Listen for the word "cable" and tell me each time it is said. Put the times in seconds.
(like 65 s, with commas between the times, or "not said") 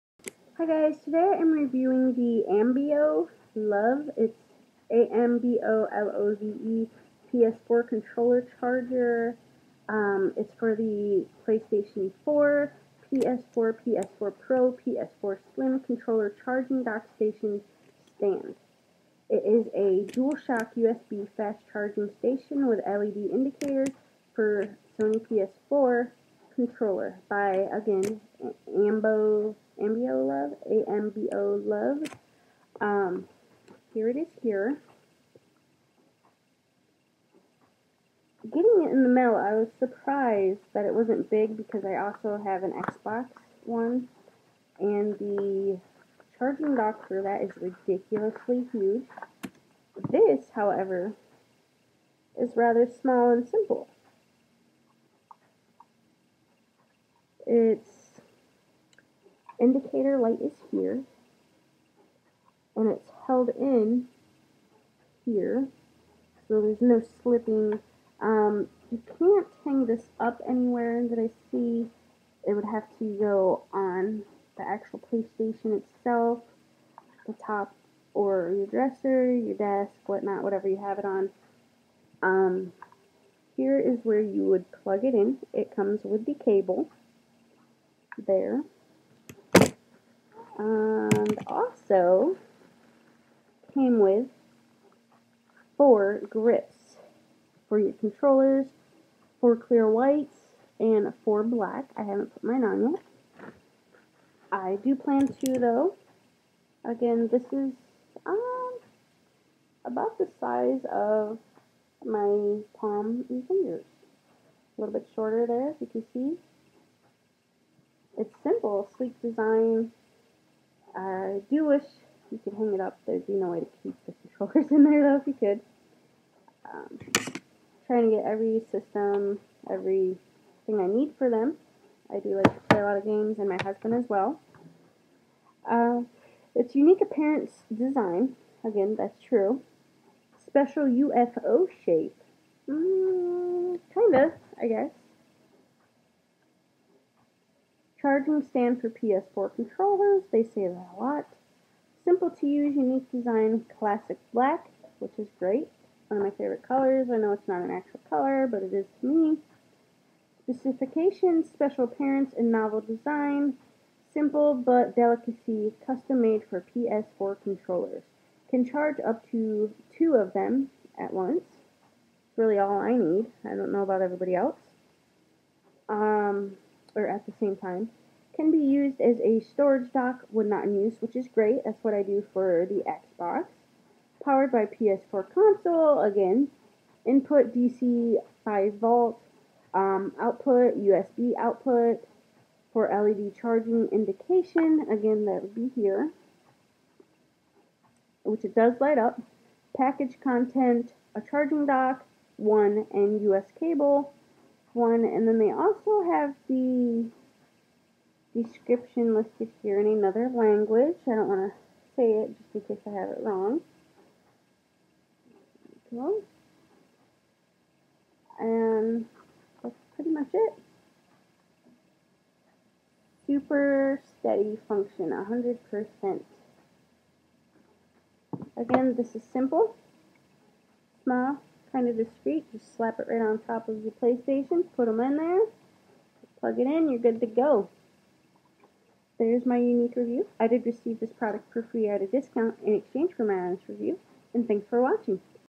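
86 s, 203 s.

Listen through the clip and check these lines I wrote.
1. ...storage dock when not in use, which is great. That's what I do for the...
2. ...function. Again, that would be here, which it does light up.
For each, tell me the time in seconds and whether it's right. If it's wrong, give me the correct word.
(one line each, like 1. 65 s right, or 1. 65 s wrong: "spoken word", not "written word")
1. 179 s right
2. 193 s wrong: "indication", not "function".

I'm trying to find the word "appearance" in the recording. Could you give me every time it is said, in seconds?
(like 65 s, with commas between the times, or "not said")
137 s, 161 s.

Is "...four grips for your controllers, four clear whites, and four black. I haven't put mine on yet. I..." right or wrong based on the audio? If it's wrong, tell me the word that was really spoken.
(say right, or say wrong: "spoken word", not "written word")
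right.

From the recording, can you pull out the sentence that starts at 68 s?
Um, you can't hang this up anywhere that I see.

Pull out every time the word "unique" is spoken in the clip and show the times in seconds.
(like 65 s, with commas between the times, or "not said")
136 s, 152 s, 239 s.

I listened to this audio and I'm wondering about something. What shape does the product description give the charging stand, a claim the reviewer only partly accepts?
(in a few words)
UFO shape.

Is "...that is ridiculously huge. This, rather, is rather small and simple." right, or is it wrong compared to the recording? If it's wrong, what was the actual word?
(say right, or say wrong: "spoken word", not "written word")
wrong: "however", not "rather".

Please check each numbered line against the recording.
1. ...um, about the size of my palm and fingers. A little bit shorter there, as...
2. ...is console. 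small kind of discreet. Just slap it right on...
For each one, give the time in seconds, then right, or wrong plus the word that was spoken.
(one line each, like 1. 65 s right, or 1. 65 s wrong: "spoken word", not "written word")
1. 108 s right
2. 229 s wrong: "simple", not "console".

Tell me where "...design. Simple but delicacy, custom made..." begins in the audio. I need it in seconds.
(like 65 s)
162 s.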